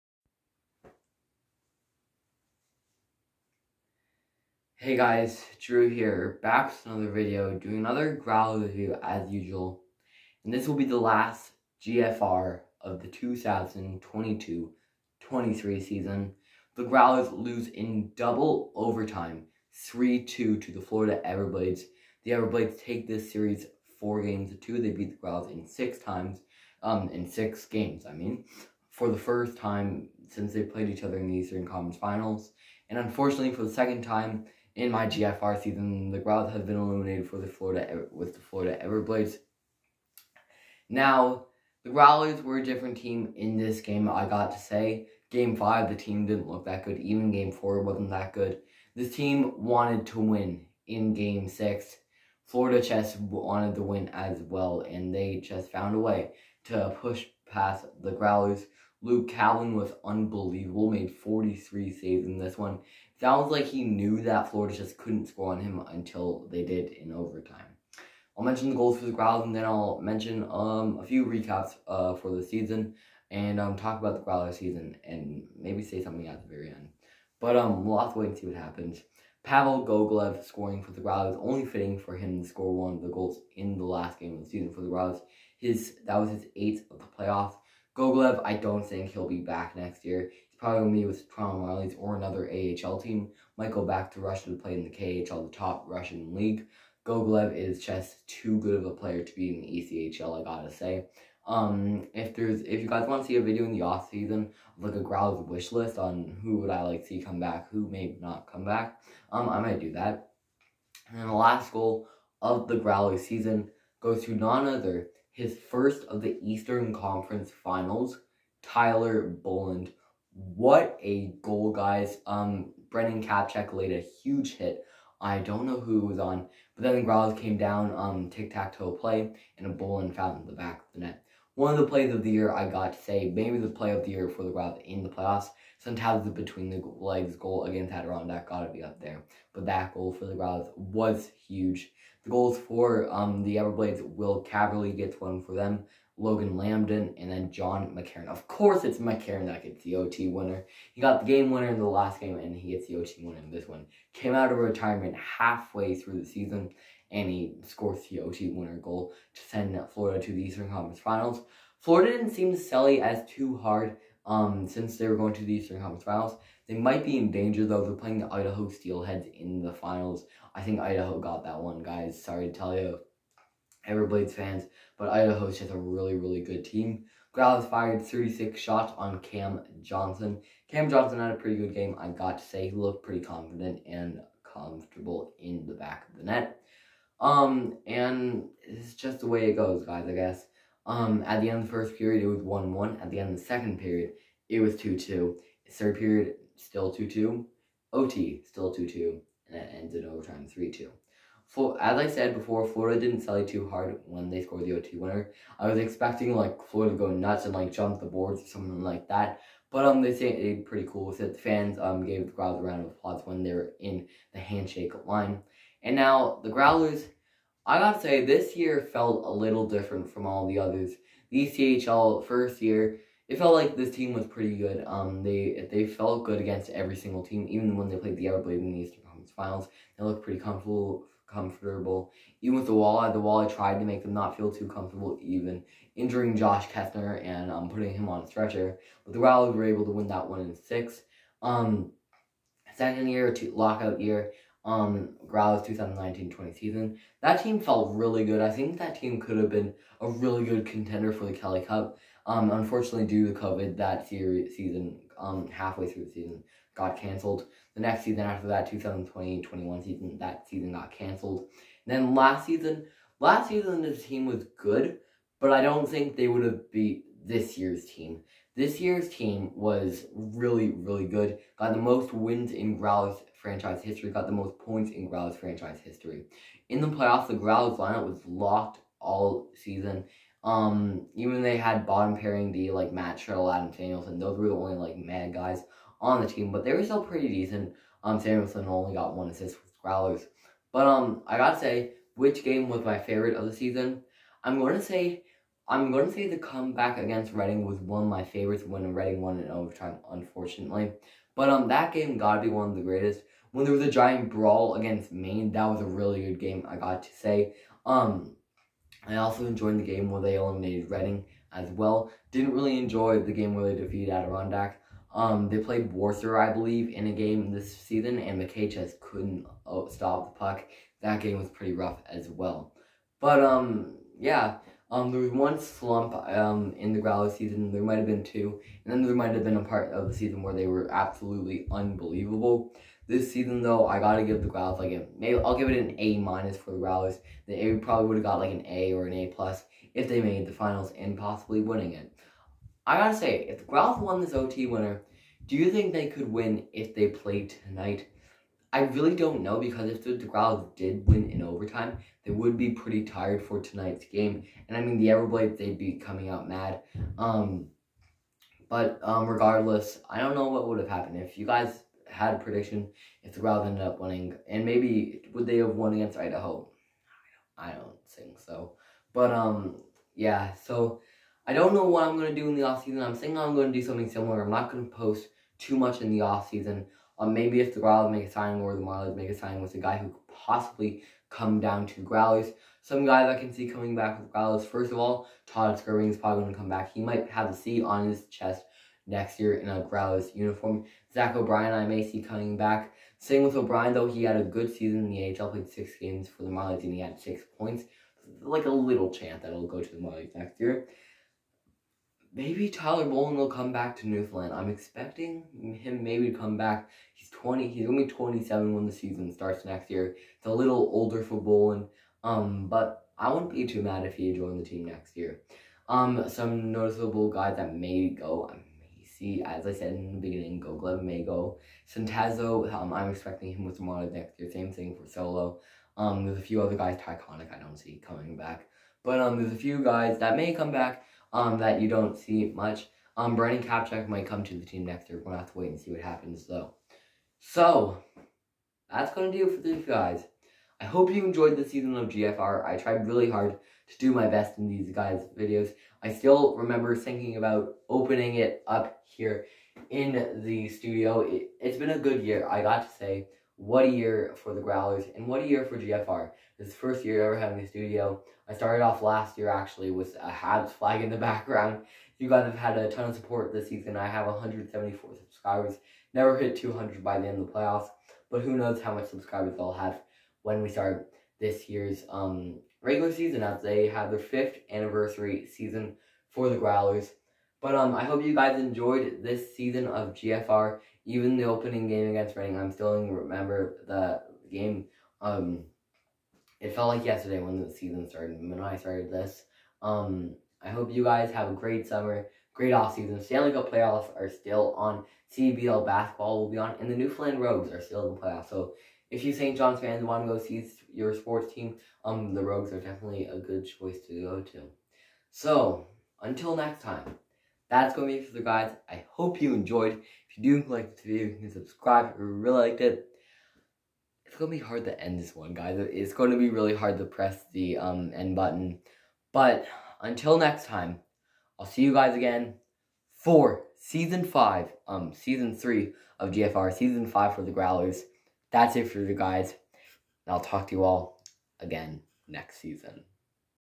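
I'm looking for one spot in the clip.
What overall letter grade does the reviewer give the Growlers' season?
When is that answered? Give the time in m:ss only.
5:35.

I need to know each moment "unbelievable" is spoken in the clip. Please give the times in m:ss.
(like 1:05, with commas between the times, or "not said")
1:00, 5:31.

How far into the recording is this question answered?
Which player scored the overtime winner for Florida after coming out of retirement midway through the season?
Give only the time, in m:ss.
2:27.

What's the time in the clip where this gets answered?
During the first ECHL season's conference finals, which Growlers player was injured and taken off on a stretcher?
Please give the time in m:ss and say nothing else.
3:56.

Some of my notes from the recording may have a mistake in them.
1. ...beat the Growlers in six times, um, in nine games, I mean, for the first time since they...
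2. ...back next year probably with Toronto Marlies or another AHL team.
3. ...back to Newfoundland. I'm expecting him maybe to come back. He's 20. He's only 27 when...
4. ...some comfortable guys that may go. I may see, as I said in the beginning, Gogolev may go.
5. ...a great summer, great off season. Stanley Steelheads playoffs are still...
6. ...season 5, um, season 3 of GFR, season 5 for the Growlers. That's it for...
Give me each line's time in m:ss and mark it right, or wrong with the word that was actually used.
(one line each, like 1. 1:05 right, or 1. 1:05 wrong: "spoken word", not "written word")
1. 0:24 wrong: "six", not "nine"
2. 1:29 right
3. 6:43 right
4. 6:56 wrong: "noticeable", not "comfortable"
5. 8:11 wrong: "Cup", not "Steelheads"
6. 8:43 right.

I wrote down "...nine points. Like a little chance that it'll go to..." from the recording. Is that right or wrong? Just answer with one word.
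wrong.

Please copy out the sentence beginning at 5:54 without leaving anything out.
And I mean, the Everblades, they'd be coming out mad.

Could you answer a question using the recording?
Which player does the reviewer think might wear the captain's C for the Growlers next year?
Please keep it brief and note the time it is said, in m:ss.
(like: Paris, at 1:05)
Todd Skirving, at 6:25.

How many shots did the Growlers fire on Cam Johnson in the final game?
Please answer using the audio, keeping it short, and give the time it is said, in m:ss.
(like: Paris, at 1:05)
36, at 2:58.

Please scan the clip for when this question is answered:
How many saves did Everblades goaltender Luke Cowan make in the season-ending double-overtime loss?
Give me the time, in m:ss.
1:01.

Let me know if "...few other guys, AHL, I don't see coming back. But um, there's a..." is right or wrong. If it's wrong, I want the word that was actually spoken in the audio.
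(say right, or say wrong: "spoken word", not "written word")
wrong: "Tyconic", not "AHL".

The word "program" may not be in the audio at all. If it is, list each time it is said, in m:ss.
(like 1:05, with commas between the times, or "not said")
not said.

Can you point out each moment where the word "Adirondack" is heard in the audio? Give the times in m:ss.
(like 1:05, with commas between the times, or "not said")
2:17, 5:14.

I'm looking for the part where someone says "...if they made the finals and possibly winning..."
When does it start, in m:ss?
5:39.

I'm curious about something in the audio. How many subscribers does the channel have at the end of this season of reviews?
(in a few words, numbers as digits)
174.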